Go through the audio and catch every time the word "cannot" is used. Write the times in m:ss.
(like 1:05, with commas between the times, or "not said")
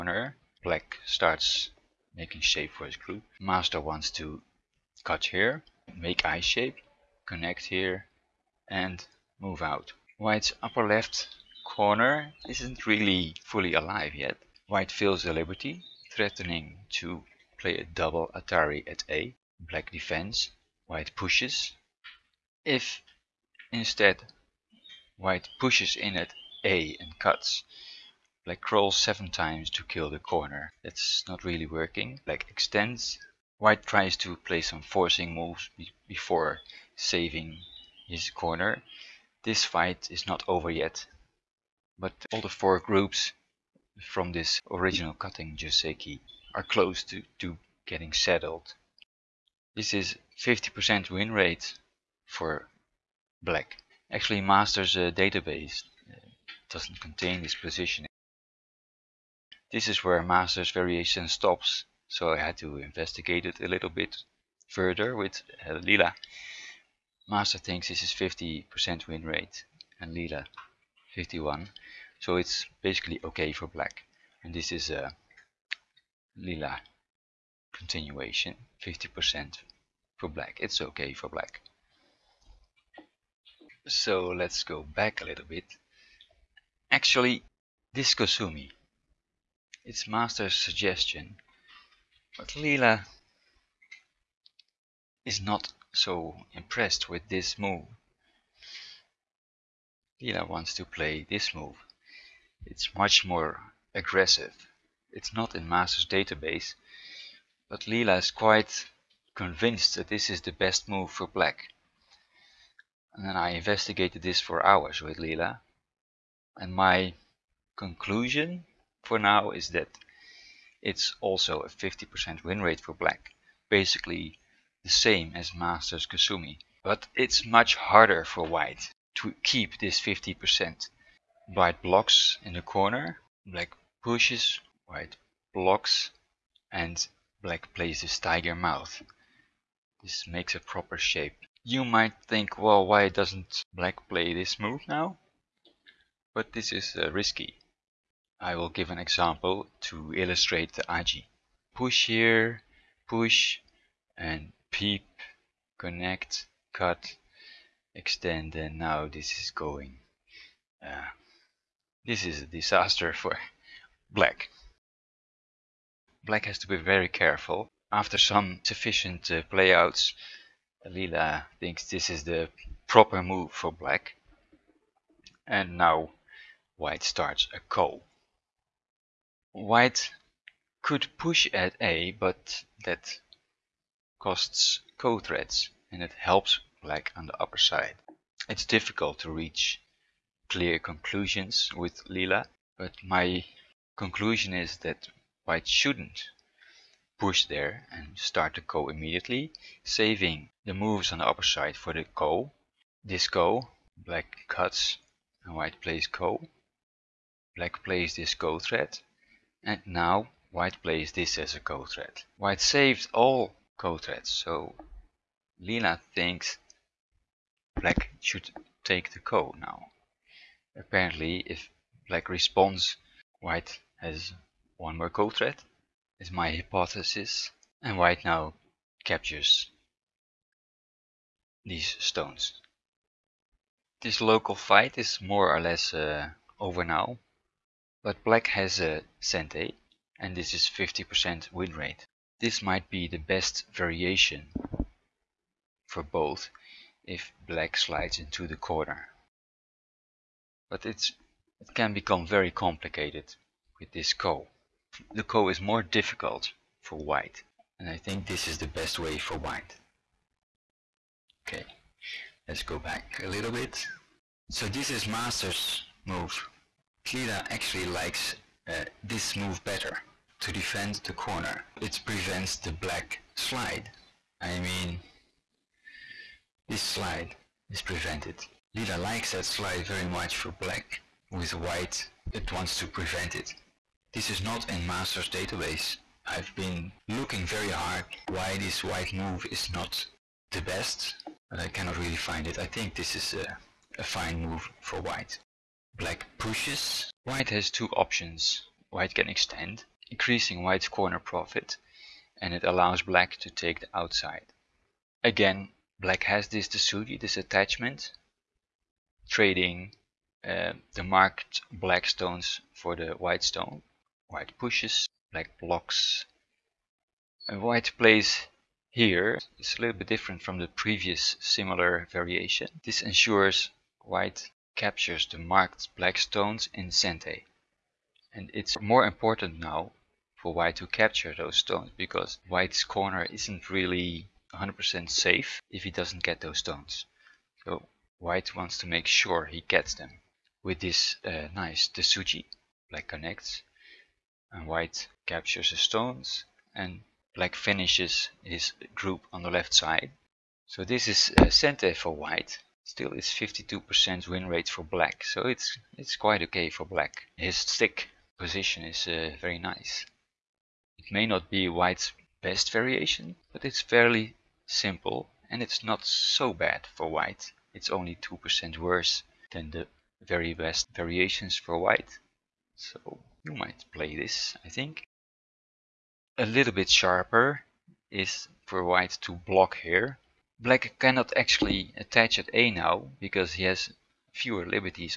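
4:51, 6:20.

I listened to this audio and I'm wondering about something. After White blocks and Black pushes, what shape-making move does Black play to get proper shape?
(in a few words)
tiger mouth.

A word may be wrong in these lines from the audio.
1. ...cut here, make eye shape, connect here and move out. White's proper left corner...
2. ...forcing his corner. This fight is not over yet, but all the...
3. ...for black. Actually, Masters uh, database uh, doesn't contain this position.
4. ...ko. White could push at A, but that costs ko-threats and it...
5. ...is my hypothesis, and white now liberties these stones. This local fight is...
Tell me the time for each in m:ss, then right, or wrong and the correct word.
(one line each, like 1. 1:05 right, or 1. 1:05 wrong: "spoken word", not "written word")
1. 0:05 wrong: "upper", not "proper"
2. 0:36 wrong: "saving", not "forcing"
3. 0:52 right
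4. 2:57 right
5. 3:46 wrong: "captures", not "liberties".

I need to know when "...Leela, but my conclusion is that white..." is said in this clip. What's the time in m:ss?
3:12.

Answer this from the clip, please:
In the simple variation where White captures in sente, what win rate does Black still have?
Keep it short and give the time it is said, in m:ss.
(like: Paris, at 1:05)
52%, at 5:53.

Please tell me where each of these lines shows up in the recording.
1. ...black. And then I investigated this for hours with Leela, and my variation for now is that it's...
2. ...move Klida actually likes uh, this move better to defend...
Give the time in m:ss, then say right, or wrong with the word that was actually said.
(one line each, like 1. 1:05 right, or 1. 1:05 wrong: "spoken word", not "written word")
1. 1:51 wrong: "conclusion", not "variation"
2. 4:26 right.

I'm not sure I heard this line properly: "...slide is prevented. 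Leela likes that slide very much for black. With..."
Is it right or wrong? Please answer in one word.
right.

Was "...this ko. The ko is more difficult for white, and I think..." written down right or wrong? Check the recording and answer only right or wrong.
right.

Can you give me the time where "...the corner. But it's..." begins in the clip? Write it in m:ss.
4:08.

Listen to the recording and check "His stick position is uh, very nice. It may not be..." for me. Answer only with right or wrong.
right.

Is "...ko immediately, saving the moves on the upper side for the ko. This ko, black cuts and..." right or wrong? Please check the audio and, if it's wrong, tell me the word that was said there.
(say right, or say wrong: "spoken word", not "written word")
right.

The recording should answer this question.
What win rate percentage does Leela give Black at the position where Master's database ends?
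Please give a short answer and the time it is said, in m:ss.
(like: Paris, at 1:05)
51, at 1:11.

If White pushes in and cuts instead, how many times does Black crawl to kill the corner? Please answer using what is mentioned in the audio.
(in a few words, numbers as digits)
7.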